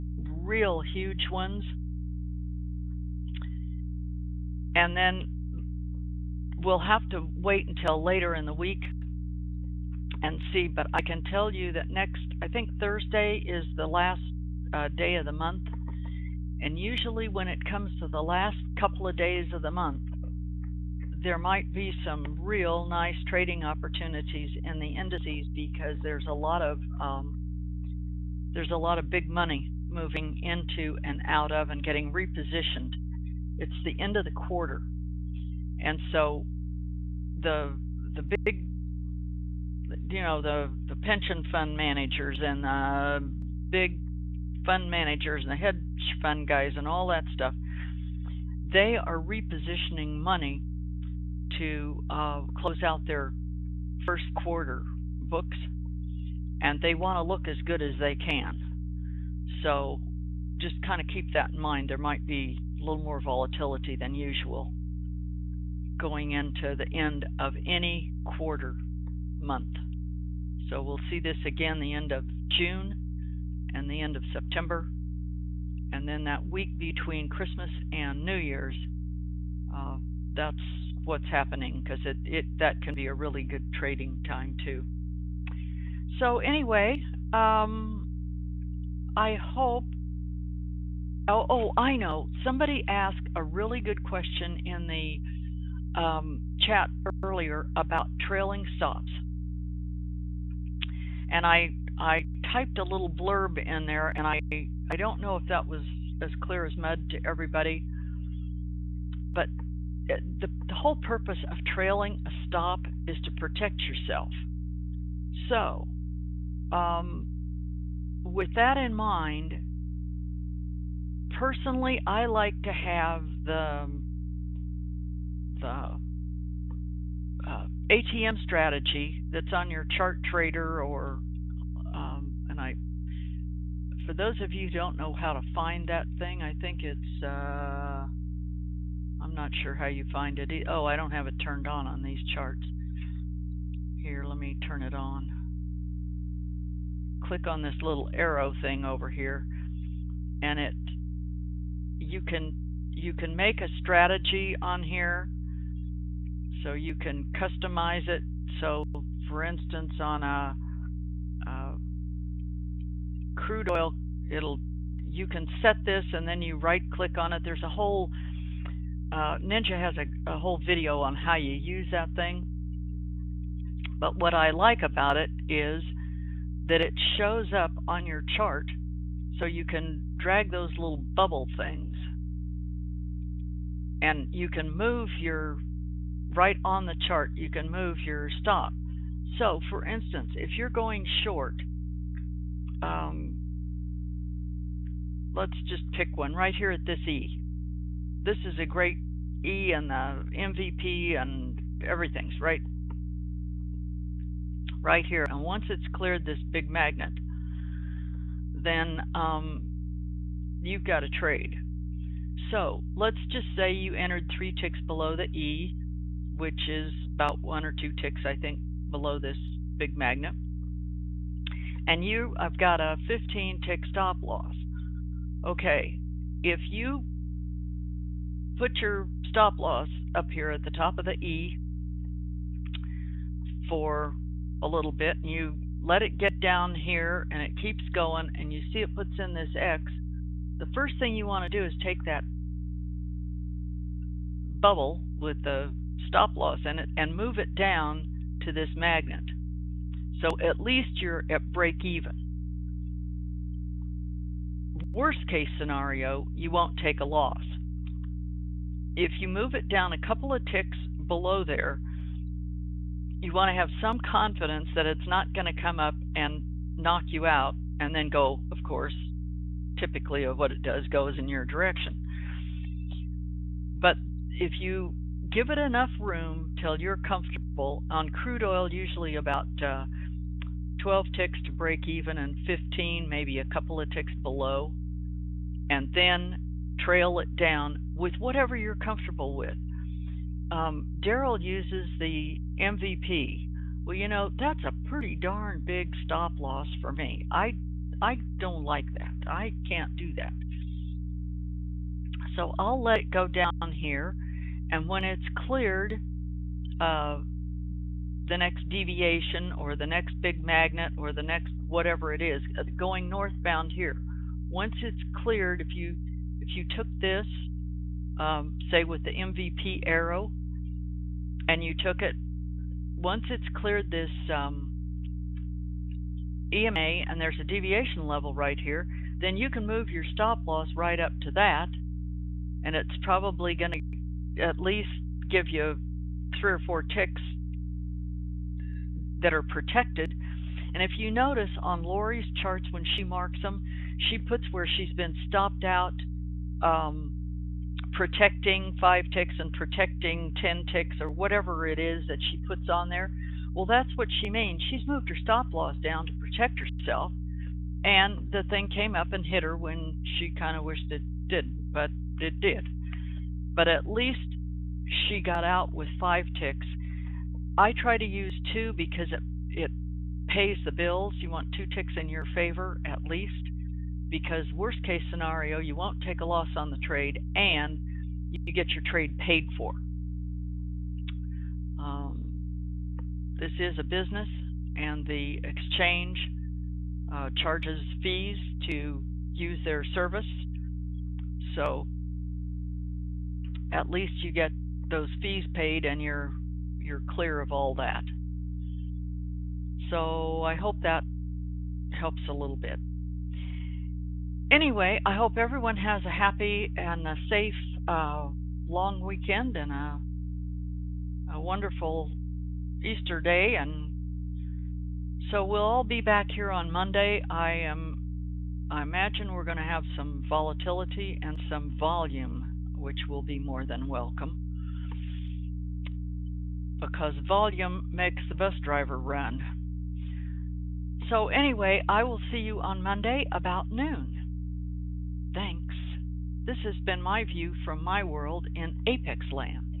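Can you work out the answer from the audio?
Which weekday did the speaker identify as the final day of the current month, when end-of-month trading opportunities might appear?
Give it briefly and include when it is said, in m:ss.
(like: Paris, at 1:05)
Thursday, at 0:12.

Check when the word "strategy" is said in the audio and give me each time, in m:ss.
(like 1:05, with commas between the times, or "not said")
2:08, 2:33.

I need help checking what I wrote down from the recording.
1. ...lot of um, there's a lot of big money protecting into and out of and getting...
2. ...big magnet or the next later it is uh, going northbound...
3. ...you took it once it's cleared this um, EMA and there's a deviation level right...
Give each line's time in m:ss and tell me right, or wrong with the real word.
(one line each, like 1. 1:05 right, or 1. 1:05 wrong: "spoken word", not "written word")
1. 0:26 wrong: "moving", not "protecting"
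2. 5:10 wrong: "whatever", not "later"
3. 5:21 right.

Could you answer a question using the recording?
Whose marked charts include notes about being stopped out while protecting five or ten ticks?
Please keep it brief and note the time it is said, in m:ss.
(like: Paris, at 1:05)
Lori, at 5:41.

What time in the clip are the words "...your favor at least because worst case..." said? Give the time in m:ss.
6:12.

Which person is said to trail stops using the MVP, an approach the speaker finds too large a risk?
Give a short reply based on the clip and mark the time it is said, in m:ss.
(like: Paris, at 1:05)
Daryl, at 4:51.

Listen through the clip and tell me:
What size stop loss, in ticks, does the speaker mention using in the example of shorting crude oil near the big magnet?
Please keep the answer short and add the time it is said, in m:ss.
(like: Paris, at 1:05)
15 ticks, at 3:43.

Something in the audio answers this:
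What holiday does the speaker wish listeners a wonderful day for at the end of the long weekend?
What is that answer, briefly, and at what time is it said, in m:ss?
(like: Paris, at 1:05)
Easter, at 6:52.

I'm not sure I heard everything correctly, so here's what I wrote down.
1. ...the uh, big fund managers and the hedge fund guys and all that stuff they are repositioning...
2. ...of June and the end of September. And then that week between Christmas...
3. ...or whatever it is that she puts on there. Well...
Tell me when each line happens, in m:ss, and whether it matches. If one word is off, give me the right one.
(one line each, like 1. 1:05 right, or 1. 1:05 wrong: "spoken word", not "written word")
1. 0:42 right
2. 1:12 right
3. 5:51 right.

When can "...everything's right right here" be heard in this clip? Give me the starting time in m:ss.
3:21.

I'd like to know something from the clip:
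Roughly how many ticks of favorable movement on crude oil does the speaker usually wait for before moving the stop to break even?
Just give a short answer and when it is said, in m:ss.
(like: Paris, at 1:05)
12 ticks, at 4:40.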